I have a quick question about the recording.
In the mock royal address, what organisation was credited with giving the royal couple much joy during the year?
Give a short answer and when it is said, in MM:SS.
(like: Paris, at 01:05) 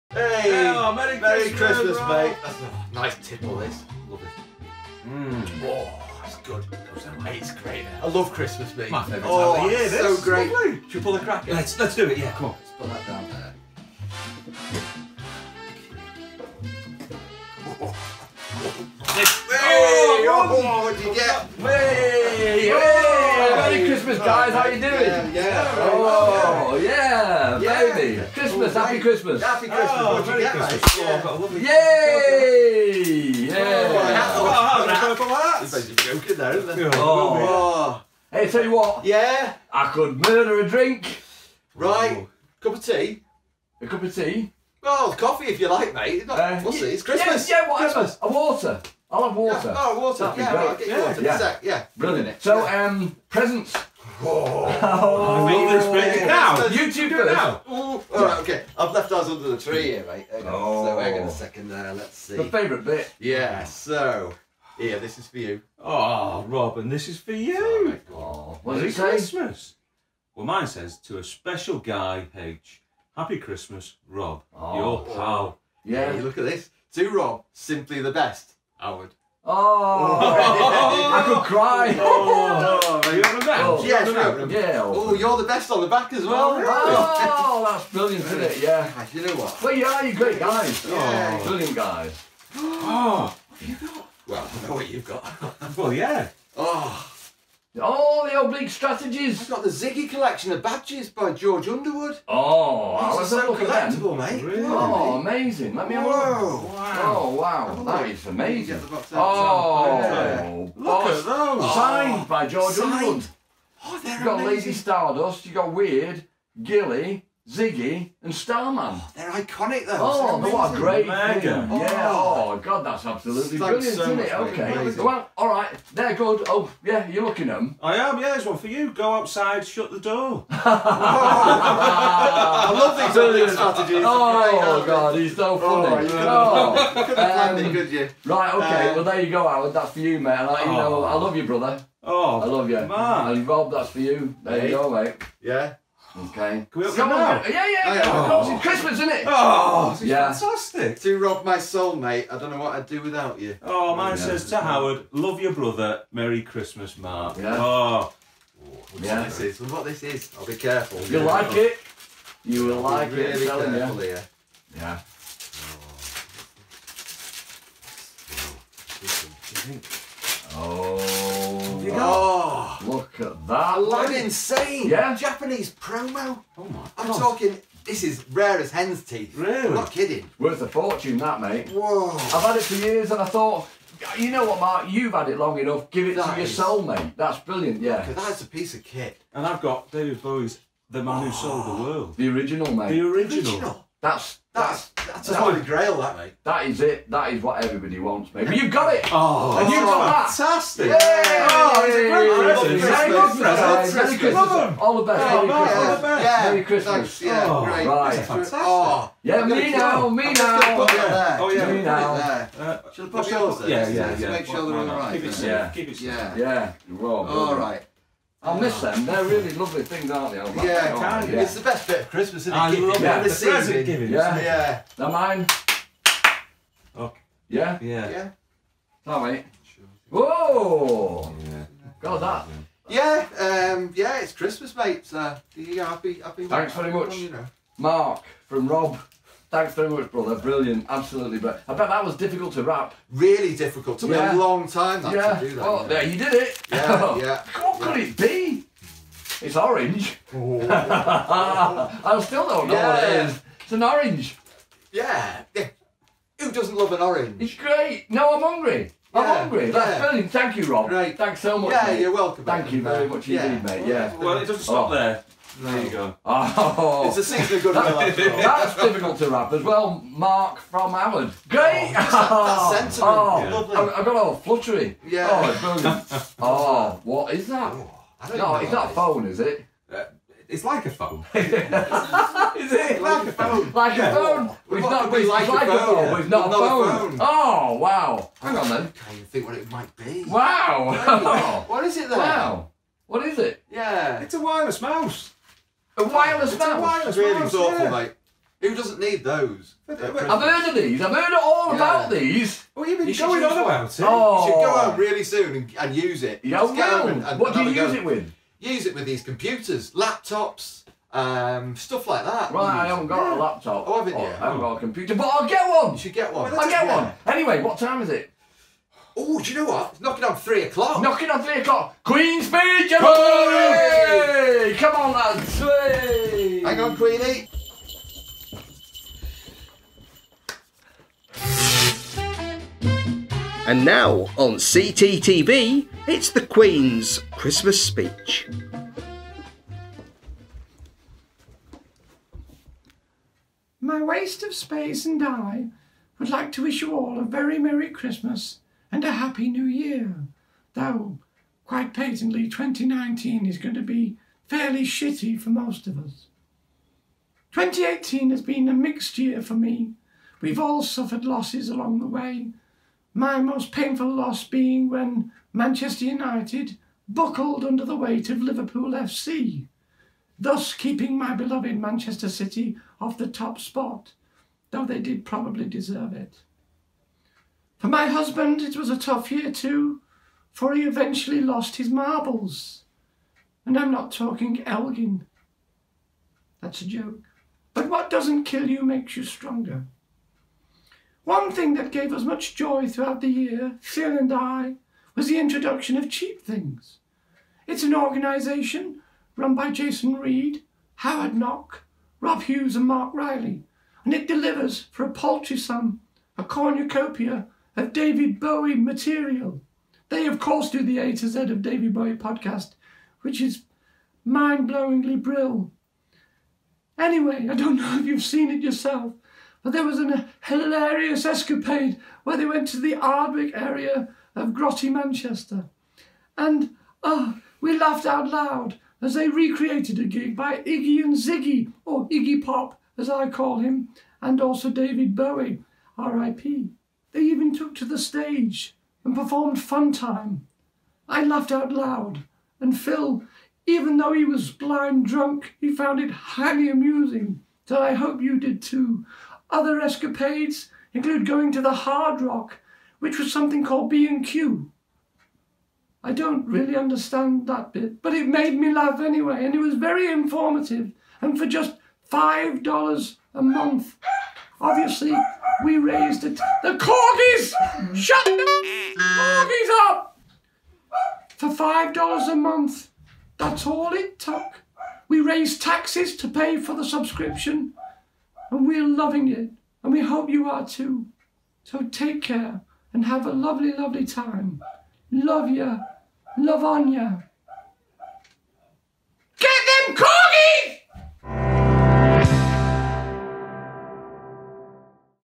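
Cheap Things, at 06:36.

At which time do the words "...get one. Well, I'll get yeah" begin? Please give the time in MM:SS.
05:16.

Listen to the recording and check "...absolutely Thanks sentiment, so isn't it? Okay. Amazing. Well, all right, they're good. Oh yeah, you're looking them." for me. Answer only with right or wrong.
wrong.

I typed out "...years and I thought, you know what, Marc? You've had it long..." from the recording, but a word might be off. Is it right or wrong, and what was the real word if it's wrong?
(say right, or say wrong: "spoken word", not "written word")
right.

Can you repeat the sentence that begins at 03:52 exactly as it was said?
Yeah, um, yeah, it's Christmas, mate.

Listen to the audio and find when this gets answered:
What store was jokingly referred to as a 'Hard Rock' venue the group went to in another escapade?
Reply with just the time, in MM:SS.
07:33.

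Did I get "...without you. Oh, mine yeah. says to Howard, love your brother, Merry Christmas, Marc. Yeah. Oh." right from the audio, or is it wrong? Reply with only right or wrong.
right.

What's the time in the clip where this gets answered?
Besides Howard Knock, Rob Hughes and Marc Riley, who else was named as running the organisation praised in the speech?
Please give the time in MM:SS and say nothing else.
06:39.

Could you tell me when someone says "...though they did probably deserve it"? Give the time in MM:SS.
06:14.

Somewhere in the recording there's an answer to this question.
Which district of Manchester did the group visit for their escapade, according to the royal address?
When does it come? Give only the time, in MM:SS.
07:02.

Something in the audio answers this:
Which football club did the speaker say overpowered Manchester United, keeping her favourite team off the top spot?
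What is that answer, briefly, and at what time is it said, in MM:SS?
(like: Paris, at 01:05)
Liverpool FC, at 06:08.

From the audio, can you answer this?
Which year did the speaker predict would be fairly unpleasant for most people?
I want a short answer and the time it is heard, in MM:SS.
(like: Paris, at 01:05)
2019, at 05:52.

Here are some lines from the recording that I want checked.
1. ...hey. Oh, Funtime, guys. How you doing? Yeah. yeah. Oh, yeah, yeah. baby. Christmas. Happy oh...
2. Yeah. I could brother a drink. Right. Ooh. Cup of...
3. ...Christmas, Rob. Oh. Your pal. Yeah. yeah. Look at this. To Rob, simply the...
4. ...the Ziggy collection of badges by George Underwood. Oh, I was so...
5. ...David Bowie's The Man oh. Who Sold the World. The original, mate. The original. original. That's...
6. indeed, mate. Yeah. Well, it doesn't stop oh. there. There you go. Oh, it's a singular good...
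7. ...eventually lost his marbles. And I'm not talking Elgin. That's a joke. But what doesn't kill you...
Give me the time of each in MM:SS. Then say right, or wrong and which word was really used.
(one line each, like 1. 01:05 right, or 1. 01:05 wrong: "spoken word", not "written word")
1. 00:22 wrong: "Christmas", not "Funtime"
2. 00:39 wrong: "murder", not "brother"
3. 01:13 right
4. 01:39 right
5. 03:09 right
6. 04:23 right
7. 06:20 right.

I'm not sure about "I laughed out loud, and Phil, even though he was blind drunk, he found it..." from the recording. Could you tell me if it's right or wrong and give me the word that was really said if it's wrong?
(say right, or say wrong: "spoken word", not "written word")
right.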